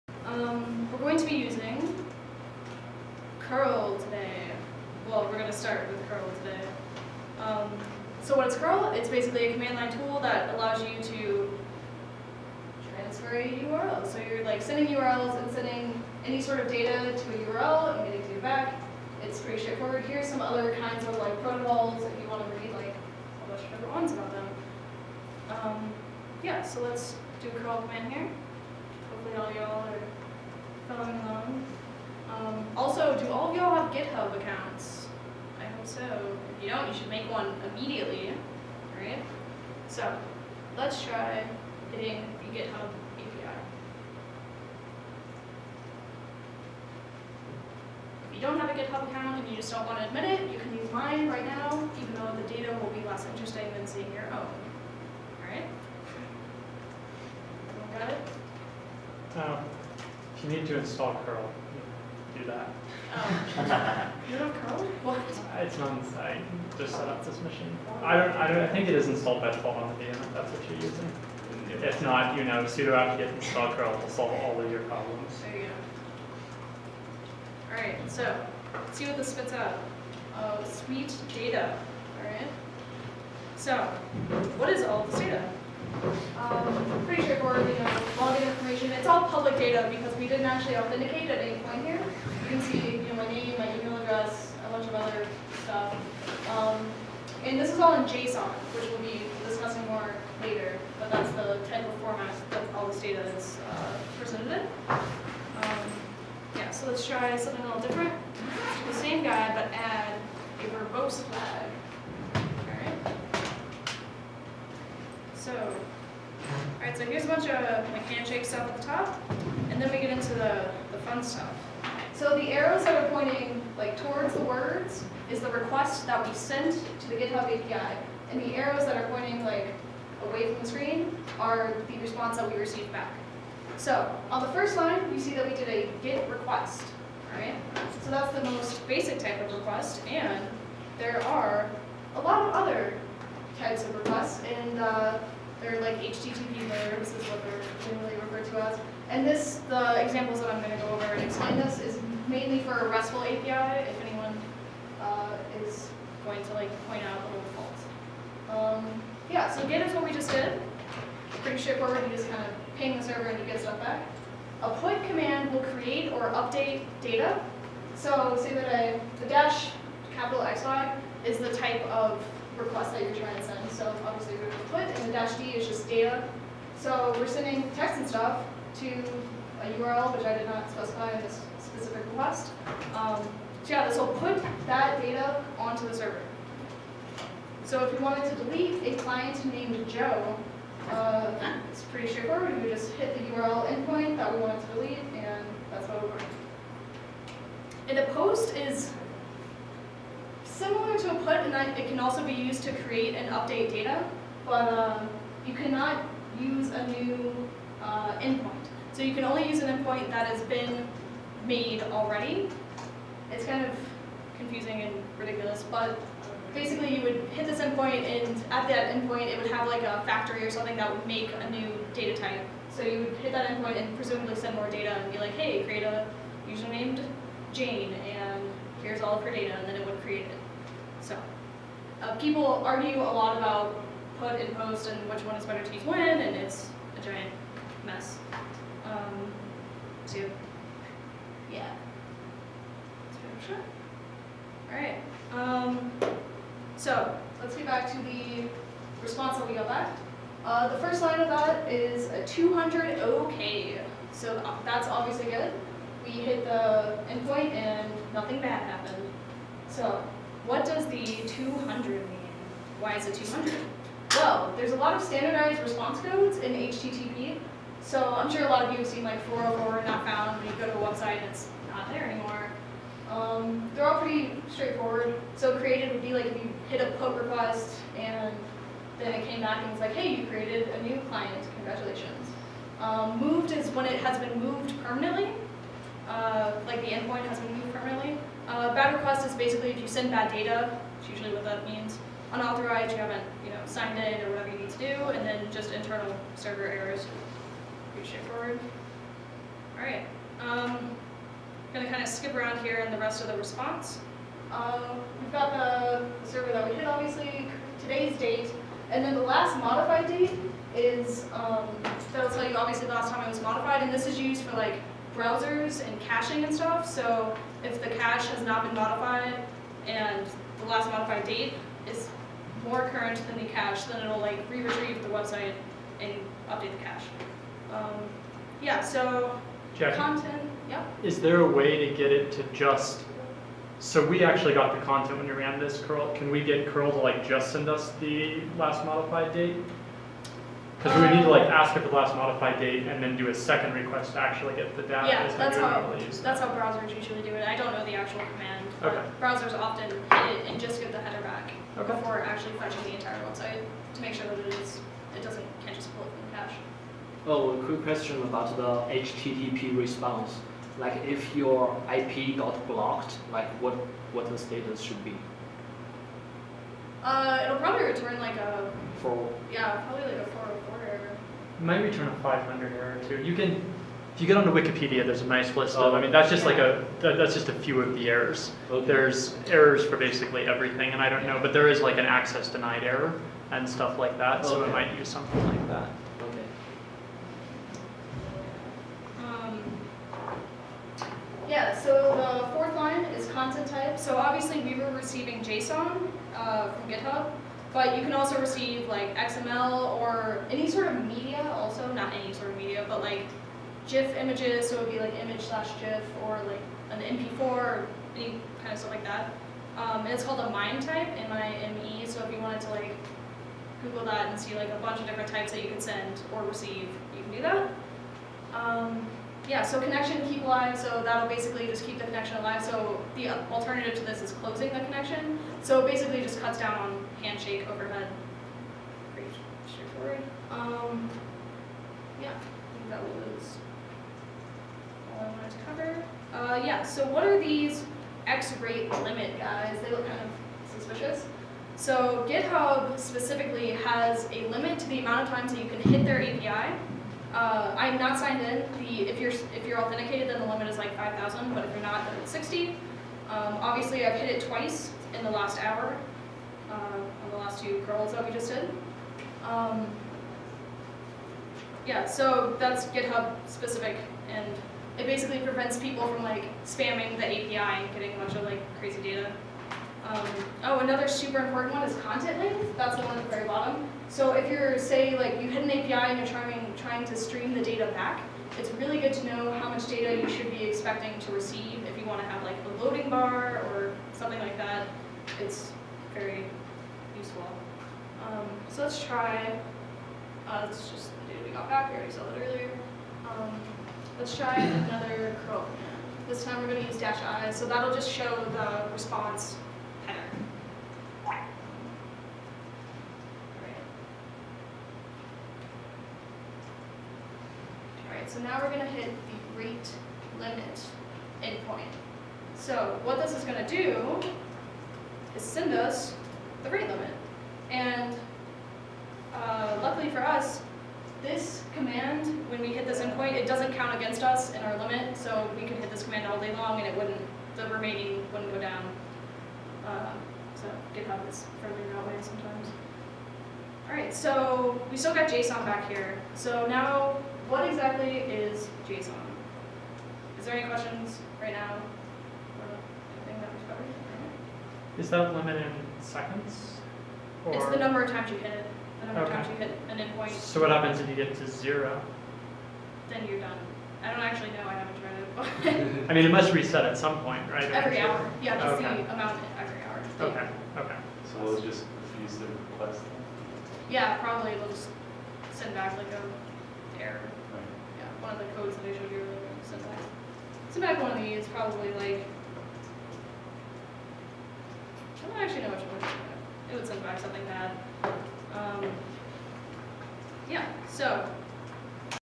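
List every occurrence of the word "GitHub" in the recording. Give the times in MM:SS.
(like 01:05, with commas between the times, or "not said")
00:33, 00:42, 00:48, 02:07, 06:36, 07:22, 07:42, 08:50.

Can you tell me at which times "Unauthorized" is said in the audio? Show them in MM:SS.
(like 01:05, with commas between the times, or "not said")
04:52.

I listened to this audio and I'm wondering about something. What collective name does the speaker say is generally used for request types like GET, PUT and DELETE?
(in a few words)
HTTP verbs.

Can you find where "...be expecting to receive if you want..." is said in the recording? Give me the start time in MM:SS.
08:00.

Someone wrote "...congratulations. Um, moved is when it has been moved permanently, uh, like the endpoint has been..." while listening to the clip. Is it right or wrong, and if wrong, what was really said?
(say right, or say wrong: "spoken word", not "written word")
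right.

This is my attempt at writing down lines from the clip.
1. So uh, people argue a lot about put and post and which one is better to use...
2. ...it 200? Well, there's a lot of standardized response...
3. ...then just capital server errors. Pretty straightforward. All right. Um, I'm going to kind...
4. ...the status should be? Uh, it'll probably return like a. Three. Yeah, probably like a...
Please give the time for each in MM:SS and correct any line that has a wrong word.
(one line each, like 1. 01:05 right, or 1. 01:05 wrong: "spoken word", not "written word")
1. 03:51 right
2. 04:23 right
3. 04:55 wrong: "internal", not "capital"
4. 06:04 wrong: "Four", not "Three".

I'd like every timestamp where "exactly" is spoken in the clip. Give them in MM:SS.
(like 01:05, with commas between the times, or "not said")
08:57.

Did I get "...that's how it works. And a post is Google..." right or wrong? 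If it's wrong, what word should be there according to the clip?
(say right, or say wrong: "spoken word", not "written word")
wrong: "Similar", not "Google".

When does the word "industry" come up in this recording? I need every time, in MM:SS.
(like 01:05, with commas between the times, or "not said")
not said.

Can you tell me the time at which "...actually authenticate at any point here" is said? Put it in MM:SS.
01:30.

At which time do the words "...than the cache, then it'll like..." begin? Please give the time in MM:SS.
05:23.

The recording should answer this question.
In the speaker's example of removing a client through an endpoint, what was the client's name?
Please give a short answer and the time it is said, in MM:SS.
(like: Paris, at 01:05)
Joe, at 03:09.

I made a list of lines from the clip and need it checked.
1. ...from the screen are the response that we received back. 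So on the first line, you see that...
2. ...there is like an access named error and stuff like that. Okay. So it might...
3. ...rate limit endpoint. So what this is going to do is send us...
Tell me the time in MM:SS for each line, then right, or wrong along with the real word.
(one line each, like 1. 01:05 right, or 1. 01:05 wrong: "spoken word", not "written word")
1. 02:10 right
2. 06:21 wrong: "denied", not "named"
3. 08:29 right.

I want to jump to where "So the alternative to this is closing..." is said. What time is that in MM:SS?
07:02.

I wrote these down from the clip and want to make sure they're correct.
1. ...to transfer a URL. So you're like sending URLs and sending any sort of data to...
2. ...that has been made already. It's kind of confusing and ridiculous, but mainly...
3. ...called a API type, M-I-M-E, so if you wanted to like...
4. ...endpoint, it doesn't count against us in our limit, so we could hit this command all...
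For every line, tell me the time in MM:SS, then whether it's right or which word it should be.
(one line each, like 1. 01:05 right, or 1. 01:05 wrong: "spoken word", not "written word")
1. 00:11 right
2. 03:30 wrong: "basically", not "mainly"
3. 06:50 wrong: "MIME", not "API"
4. 08:42 right.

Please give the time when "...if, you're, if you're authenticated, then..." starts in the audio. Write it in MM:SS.
07:29.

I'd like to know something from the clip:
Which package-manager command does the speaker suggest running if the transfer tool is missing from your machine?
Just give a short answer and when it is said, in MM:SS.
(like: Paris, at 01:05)
sudo apt-get install curl, at 01:12.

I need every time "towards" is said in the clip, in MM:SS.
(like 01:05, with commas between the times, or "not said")
02:03.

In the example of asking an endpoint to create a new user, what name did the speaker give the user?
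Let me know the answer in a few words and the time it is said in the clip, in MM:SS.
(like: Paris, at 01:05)
Jane, at 03:47.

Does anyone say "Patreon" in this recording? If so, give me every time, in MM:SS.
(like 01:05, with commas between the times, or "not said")
not said.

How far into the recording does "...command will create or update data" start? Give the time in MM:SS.
02:45.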